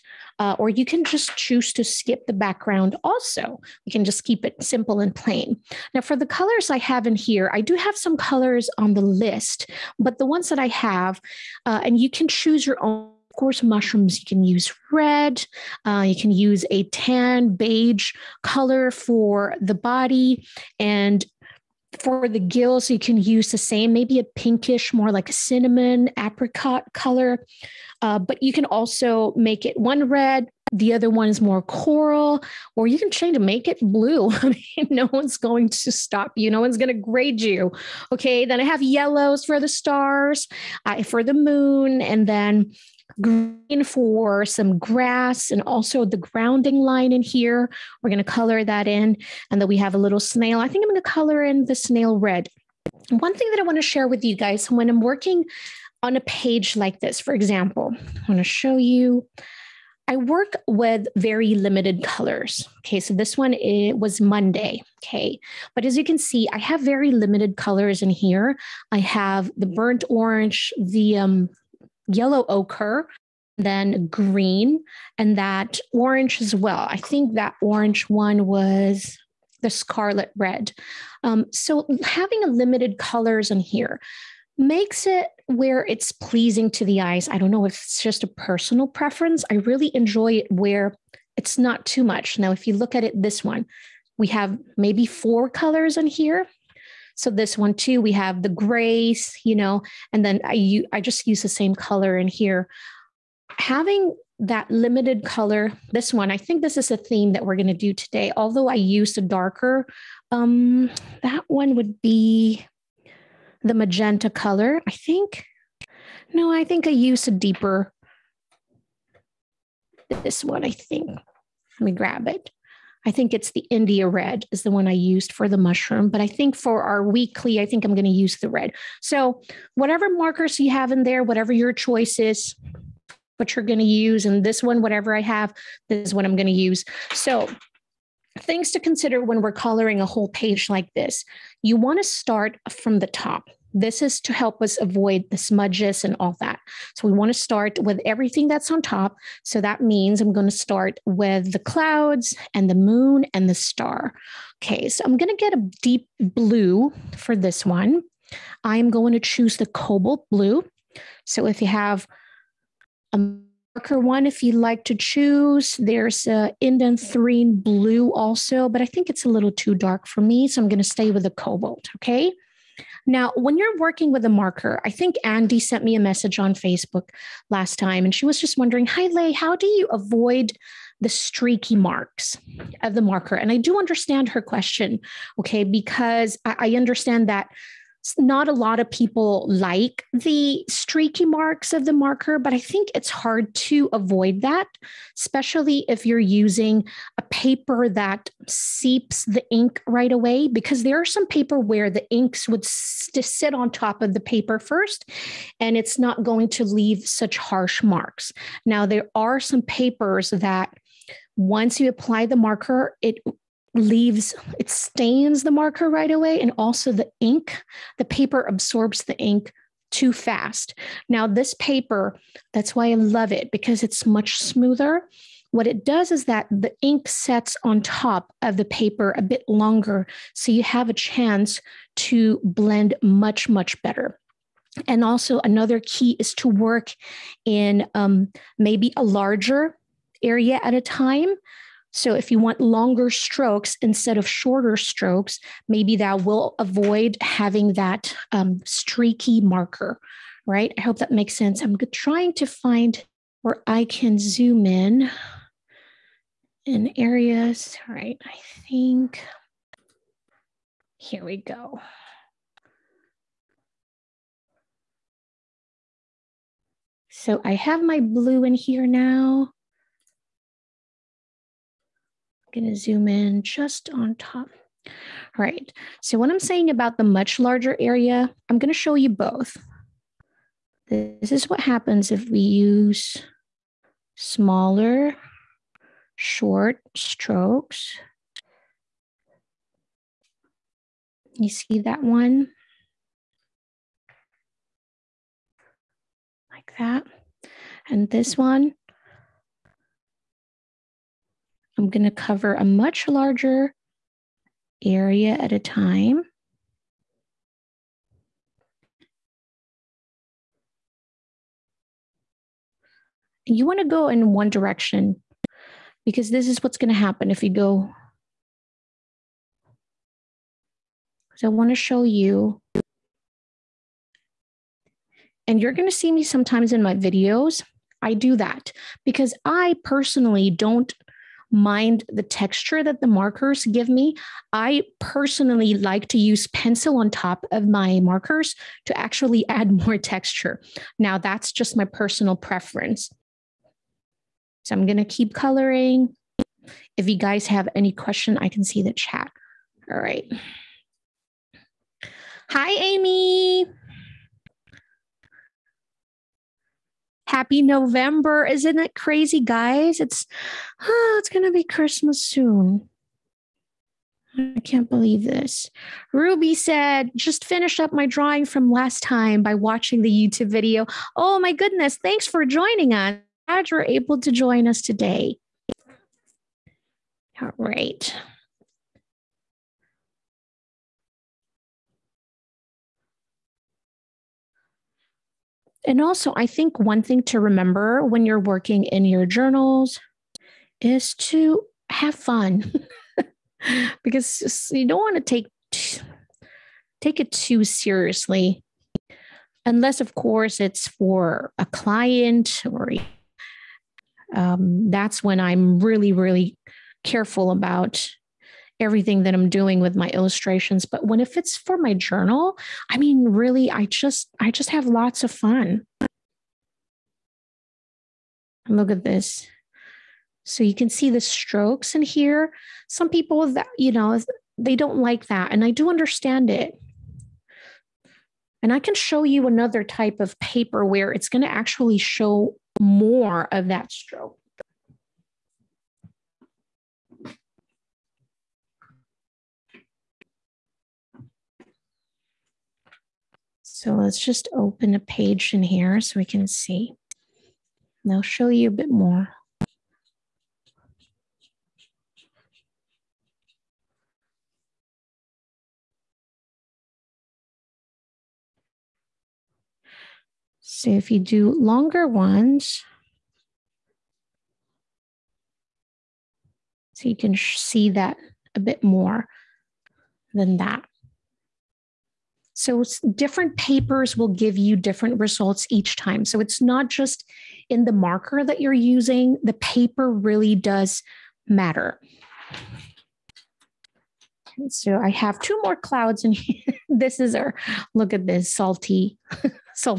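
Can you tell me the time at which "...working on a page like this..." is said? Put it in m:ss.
0:55.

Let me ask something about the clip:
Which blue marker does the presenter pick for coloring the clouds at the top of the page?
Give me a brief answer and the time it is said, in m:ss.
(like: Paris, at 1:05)
cobalt blue, at 2:39.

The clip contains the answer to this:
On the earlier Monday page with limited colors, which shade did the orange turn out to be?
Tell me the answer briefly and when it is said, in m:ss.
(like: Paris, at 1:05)
scarlet red, at 1:19.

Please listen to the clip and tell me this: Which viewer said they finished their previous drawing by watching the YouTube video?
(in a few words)
Ruby.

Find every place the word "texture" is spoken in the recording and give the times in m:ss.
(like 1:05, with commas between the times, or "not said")
5:32, 5:39.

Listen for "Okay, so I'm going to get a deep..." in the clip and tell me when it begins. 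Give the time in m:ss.
2:34.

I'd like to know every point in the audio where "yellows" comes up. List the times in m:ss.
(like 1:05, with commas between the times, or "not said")
0:38, 1:12.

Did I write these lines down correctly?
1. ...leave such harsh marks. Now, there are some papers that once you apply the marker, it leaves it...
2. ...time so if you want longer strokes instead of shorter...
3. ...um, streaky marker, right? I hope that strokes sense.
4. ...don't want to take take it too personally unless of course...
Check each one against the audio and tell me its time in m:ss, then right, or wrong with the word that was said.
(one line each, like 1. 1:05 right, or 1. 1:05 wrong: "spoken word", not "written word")
1. 3:26 right
2. 4:00 right
3. 4:08 wrong: "makes", not "strokes"
4. 6:34 wrong: "seriously", not "personally".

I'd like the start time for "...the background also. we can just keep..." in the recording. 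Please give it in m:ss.
0:02.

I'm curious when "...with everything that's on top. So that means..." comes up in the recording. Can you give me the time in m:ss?
2:27.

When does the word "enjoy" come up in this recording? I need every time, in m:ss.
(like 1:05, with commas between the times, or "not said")
1:29.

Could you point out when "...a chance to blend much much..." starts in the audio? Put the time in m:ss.
3:50.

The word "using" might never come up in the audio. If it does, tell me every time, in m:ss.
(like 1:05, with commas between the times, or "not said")
3:16, 7:58.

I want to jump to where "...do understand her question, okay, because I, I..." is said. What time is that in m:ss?
3:03.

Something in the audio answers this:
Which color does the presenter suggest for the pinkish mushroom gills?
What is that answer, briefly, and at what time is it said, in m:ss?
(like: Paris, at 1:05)
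cinnamon apricot, at 0:25.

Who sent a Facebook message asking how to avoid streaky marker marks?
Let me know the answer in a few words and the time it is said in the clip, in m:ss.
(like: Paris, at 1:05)
Andy, at 2:55.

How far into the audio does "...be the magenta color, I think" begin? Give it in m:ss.
1:52.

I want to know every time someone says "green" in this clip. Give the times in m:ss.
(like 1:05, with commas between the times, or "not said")
0:43, 1:14.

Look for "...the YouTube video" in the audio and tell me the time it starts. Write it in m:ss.
6:10.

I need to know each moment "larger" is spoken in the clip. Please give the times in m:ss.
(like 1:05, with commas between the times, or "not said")
3:59, 4:37, 5:03.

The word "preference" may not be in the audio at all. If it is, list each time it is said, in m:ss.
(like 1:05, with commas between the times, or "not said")
1:28, 5:42.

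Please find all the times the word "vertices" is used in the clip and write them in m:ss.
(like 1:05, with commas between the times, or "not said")
not said.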